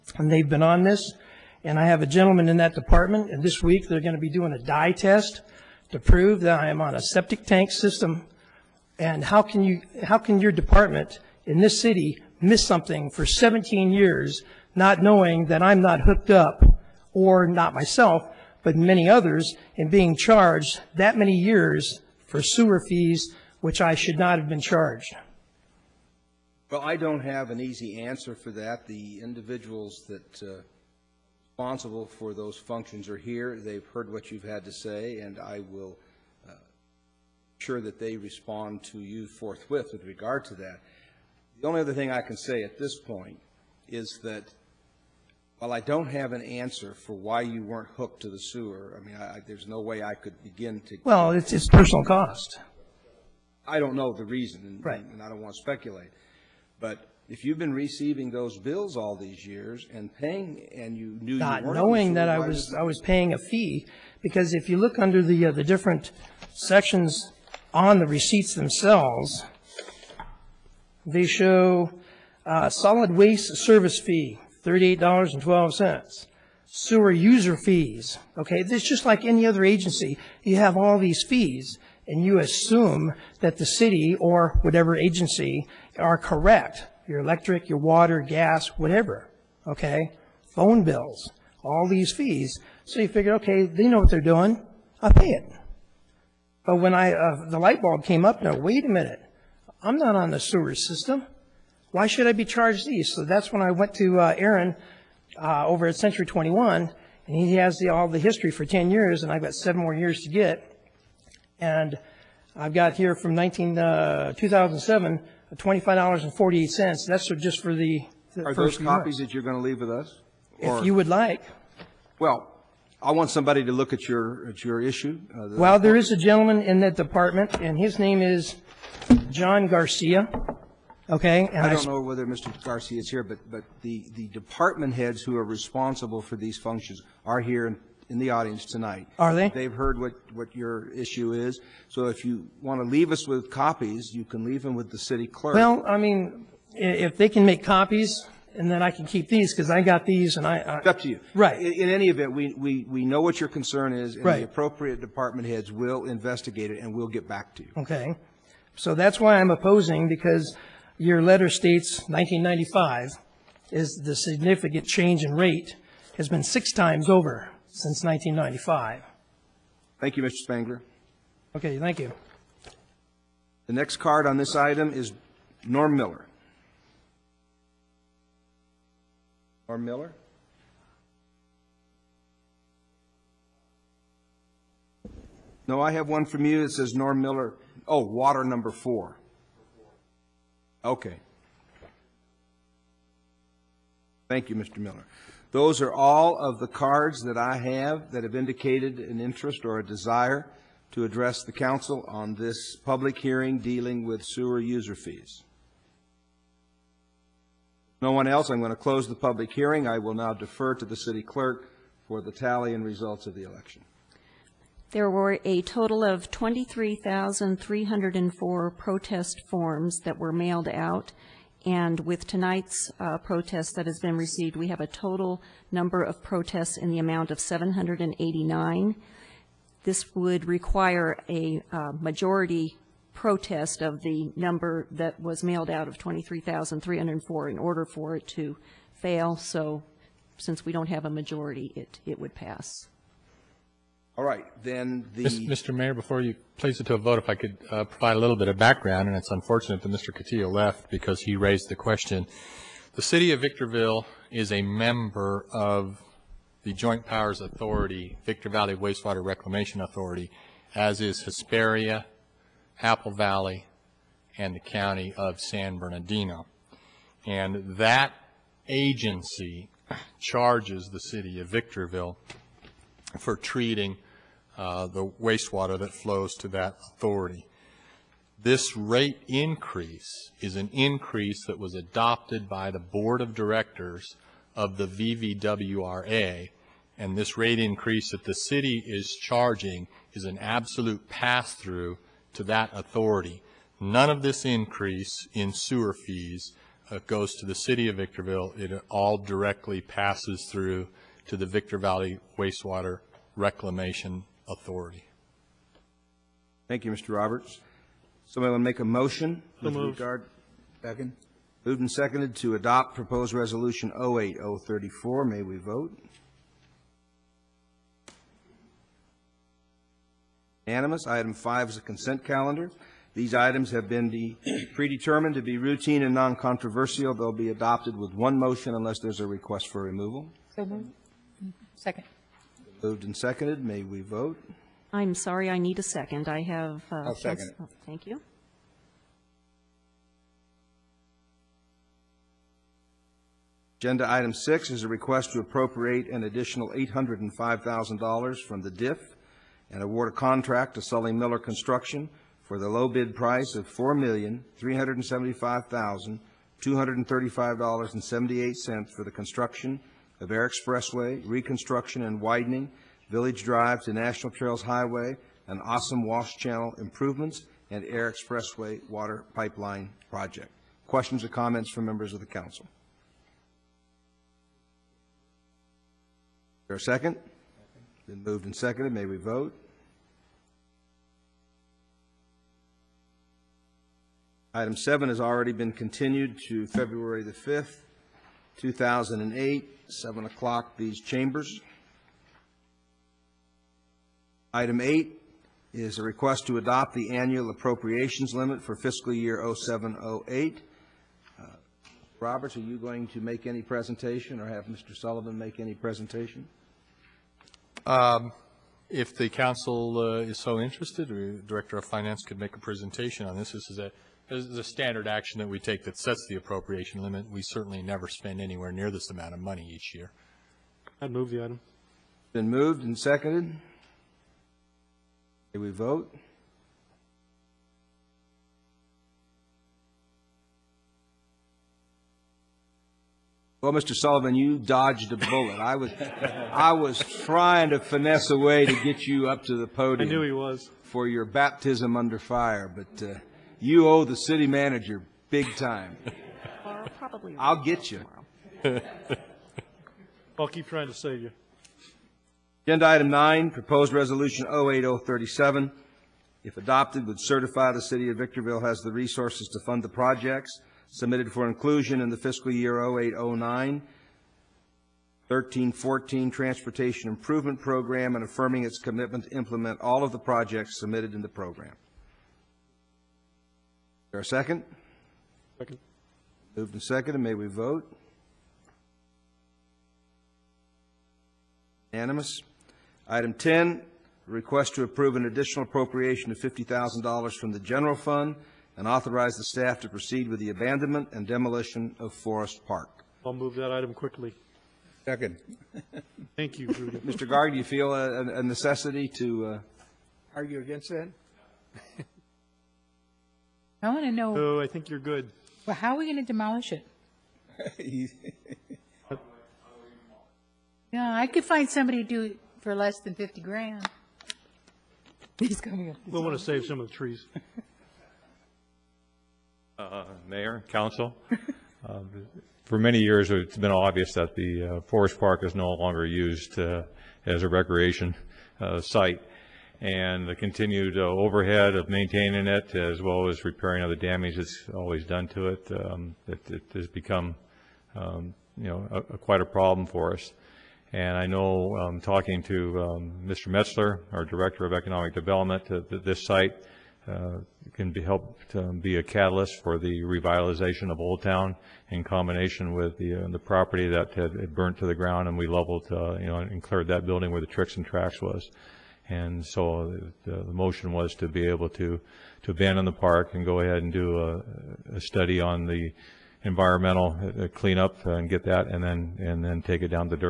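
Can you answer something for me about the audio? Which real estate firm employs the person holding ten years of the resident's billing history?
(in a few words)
Century 21.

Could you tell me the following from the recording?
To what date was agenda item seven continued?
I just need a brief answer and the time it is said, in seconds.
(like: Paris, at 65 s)
February 5, at 386 s.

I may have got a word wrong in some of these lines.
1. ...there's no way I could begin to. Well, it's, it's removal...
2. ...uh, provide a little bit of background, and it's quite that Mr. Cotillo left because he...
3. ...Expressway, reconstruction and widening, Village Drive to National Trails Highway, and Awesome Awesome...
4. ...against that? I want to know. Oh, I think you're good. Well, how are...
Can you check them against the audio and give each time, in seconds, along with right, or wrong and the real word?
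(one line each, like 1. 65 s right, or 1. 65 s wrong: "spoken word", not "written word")
1. 49 s wrong: "personal", not "removal"
2. 247 s wrong: "unfortunate", not "quite"
3. 360 s wrong: "Wash", not "Awesome"
4. 500 s right.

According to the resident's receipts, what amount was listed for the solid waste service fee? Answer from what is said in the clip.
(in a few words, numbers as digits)
$38.12.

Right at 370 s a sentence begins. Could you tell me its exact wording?
Questions or comments from members of the council?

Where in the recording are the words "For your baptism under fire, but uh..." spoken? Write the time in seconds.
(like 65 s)
440 s.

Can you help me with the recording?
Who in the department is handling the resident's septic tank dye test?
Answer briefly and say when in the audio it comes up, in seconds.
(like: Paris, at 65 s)
John Garcia, at 129 s.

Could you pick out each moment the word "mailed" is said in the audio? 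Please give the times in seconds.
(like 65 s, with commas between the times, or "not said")
220 s, 235 s.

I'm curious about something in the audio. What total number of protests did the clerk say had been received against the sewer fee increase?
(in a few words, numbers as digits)
789.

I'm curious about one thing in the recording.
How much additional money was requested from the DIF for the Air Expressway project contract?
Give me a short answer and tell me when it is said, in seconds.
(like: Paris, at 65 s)
$805,000, at 346 s.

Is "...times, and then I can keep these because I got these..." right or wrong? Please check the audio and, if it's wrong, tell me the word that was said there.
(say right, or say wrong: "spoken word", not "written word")
wrong: "copies", not "times".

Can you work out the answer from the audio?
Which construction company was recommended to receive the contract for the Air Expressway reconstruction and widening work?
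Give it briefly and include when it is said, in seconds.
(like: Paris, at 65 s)
Sully Miller Construction, at 350 s.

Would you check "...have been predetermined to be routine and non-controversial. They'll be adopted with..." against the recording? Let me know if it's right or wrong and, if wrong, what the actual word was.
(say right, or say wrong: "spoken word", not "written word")
right.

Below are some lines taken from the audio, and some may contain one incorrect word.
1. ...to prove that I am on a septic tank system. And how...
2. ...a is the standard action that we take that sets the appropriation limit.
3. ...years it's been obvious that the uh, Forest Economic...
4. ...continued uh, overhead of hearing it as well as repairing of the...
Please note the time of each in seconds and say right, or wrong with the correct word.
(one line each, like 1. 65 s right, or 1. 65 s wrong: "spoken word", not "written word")
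1. 5 s right
2. 413 s right
3. 523 s wrong: "Park", not "Economic"
4. 530 s wrong: "maintaining", not "hearing".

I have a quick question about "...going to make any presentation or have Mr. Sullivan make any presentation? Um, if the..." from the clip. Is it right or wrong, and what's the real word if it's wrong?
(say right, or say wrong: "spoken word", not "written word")
right.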